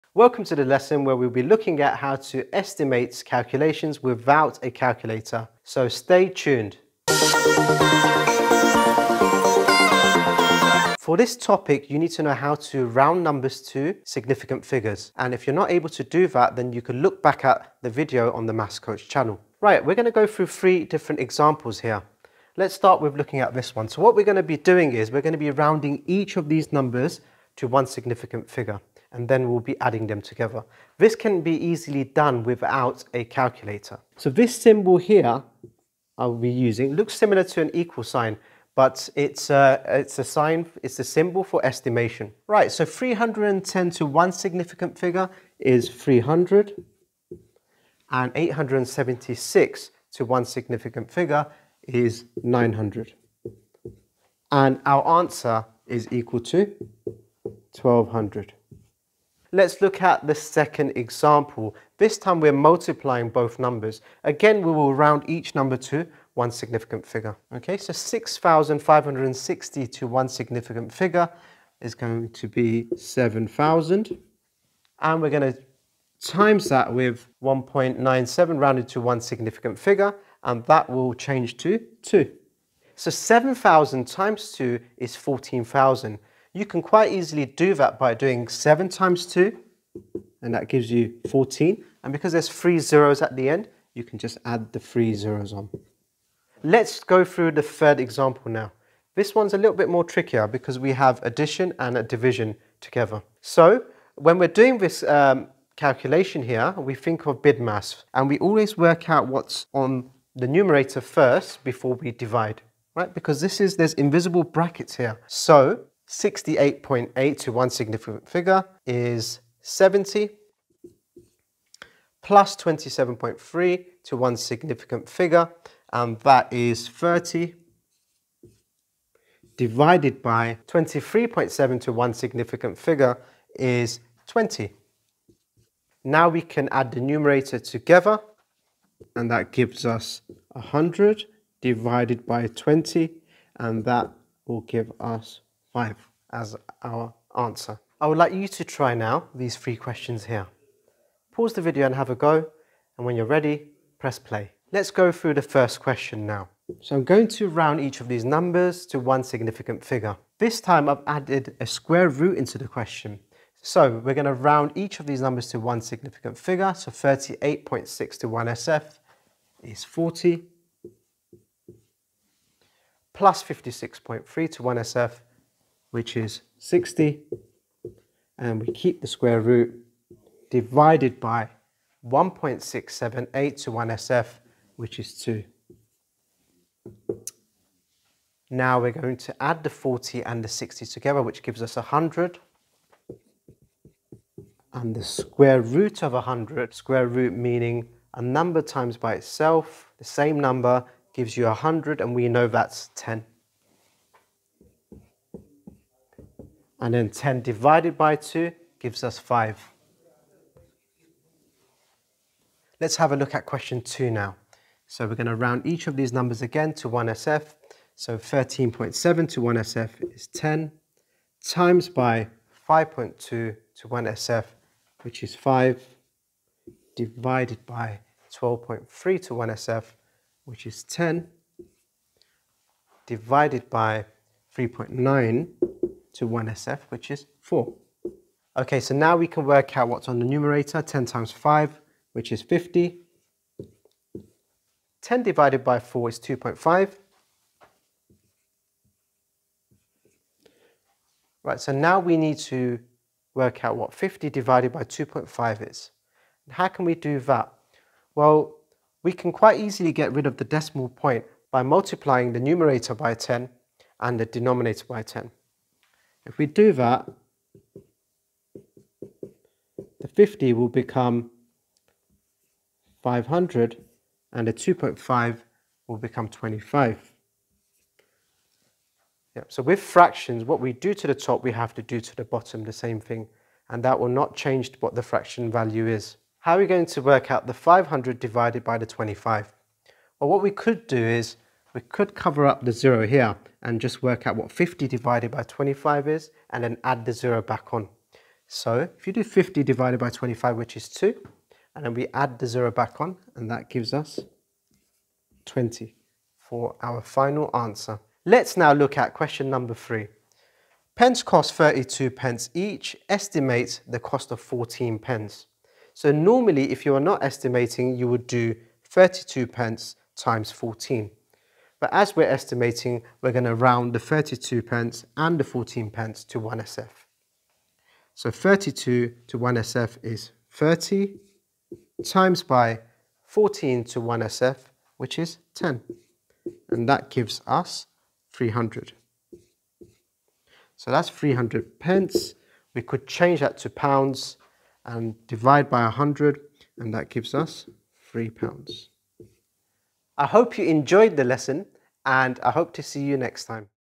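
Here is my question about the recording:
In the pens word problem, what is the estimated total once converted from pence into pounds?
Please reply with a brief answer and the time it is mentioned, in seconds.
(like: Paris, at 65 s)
3 pounds, at 348 s.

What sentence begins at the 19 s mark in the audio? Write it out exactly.
Right, we're gonna go through three different examples here.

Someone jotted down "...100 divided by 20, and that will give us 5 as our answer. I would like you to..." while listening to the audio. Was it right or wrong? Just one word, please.
right.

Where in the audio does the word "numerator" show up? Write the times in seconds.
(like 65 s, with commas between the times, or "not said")
110 s, 136 s, 240 s, 262 s.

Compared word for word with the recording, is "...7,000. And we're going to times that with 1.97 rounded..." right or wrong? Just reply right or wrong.
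right.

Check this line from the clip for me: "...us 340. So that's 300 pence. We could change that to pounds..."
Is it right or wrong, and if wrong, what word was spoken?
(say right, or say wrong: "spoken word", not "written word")
wrong: "300", not "340".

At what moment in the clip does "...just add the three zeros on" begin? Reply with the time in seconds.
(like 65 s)
94 s.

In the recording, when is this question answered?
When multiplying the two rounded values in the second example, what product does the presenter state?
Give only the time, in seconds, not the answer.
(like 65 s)
85 s.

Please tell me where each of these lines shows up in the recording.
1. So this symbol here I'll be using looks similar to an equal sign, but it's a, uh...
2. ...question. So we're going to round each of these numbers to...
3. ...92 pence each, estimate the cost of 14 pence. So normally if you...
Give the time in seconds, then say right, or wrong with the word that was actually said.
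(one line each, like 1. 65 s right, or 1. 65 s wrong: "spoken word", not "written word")
1. 34 s right
2. 162 s right
3. 311 s wrong: "32", not "92".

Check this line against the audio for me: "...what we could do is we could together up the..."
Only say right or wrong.
wrong.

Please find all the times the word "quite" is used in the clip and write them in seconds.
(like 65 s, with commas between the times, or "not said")
86 s, 259 s.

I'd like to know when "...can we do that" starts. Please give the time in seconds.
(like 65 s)
256 s.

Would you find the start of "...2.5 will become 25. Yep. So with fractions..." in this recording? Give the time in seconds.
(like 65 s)
274 s.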